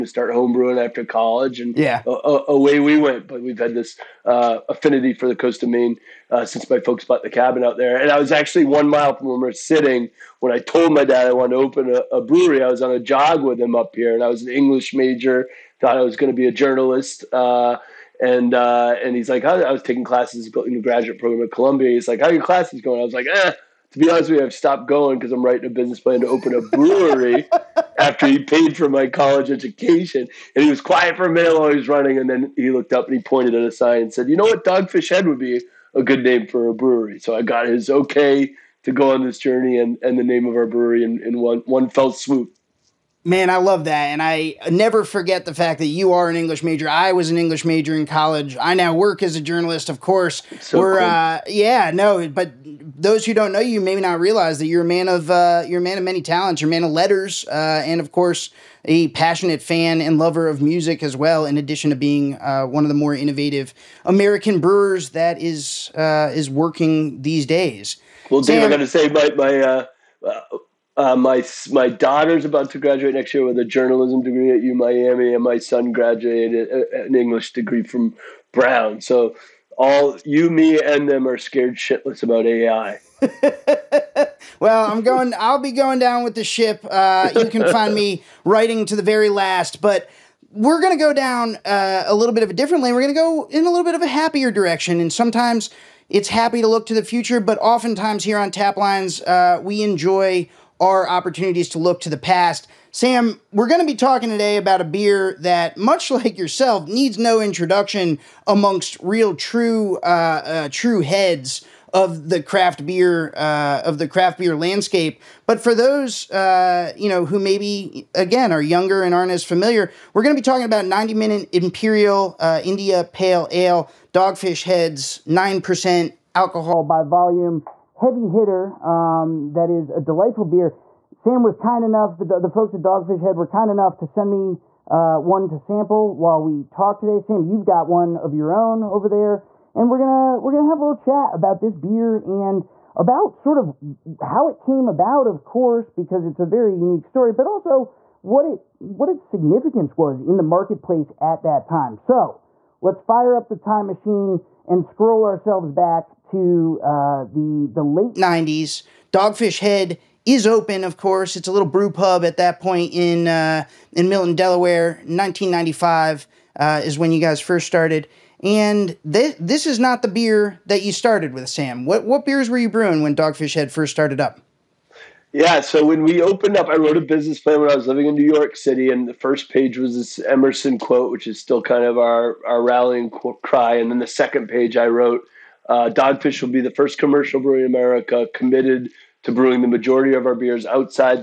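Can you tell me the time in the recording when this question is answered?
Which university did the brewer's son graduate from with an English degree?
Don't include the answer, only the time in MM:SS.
01:18.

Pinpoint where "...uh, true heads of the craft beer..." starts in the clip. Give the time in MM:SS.
01:50.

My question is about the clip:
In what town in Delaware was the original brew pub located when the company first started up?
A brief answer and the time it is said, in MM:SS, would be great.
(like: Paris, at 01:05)
Milton, at 02:44.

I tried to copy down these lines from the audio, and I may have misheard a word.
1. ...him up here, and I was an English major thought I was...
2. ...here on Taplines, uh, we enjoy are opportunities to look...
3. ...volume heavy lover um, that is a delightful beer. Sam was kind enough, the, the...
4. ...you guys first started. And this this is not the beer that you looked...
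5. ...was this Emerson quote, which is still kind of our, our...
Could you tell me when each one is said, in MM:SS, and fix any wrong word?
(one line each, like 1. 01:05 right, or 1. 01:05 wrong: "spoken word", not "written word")
1. 00:13 right
2. 01:38 right
3. 02:07 wrong: "hitter", not "lover"
4. 02:47 wrong: "started", not "looked"
5. 02:59 right.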